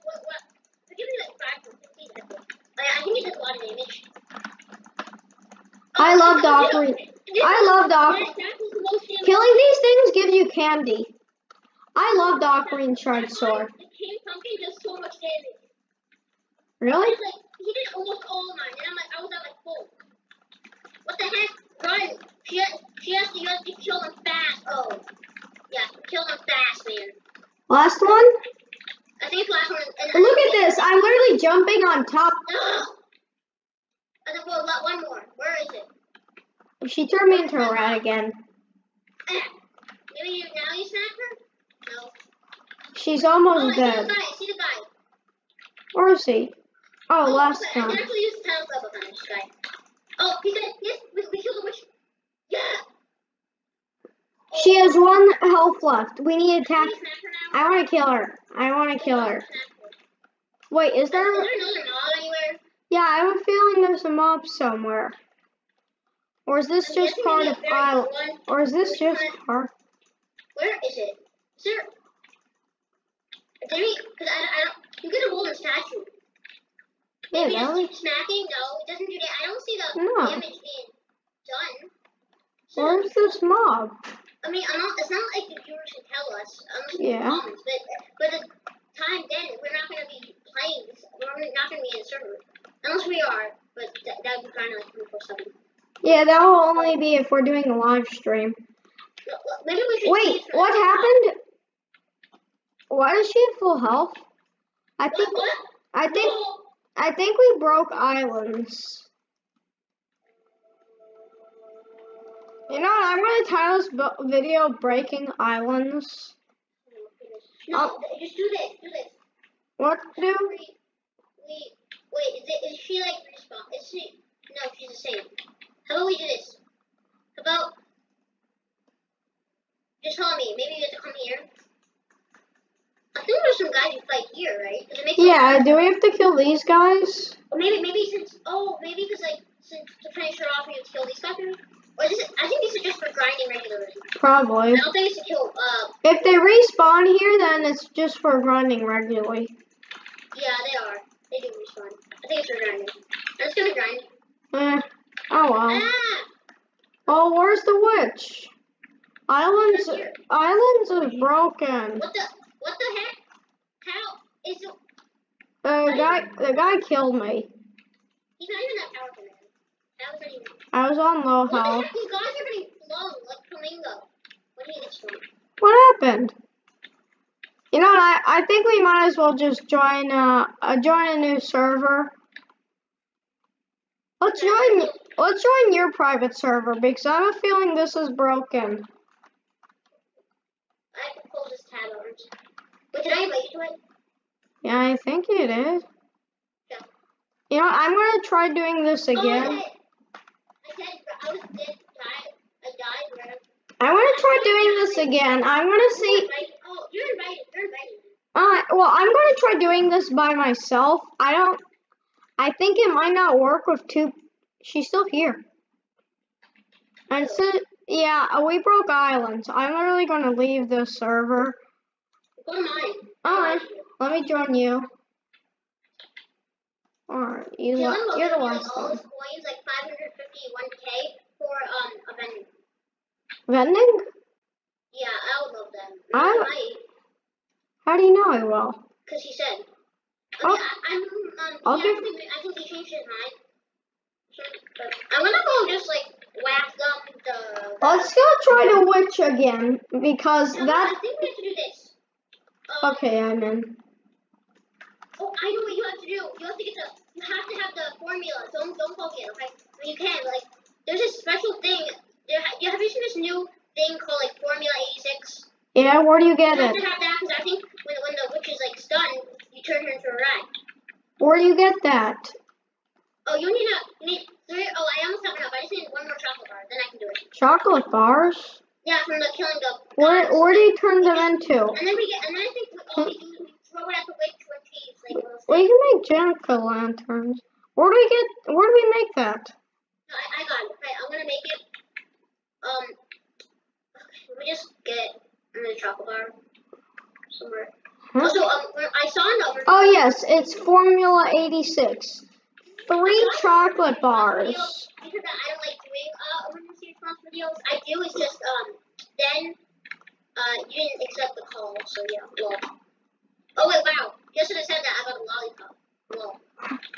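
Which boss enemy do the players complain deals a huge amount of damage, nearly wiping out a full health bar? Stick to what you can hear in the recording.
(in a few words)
King Pumpkin.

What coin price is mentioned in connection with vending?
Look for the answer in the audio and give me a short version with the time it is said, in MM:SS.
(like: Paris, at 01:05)
1k, at 03:50.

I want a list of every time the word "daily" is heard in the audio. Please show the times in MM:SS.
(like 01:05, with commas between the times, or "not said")
not said.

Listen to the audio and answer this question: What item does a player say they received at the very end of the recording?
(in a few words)
A lollipop.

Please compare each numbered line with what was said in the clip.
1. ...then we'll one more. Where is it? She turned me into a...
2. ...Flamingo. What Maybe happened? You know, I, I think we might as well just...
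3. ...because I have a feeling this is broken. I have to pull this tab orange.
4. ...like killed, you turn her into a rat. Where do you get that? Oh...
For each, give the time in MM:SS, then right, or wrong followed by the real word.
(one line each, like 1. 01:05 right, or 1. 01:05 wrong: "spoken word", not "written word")
1. 00:34 right
2. 02:53 wrong: "What", not "Maybe"
3. 03:06 right
4. 04:28 wrong: "stunned", not "killed".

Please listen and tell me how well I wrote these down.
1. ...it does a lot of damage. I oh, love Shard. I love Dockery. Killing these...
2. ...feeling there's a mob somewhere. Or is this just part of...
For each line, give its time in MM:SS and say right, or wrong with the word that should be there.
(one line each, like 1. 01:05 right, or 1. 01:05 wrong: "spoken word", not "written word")
1. 00:03 wrong: "Dockery", not "Shard"
2. 01:03 right.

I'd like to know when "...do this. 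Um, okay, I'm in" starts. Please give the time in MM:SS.
04:11.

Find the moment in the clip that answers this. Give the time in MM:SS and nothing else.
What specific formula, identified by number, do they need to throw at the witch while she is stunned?
05:00.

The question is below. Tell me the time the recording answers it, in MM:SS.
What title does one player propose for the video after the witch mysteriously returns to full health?
01:54.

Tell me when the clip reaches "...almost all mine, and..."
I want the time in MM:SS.
00:17.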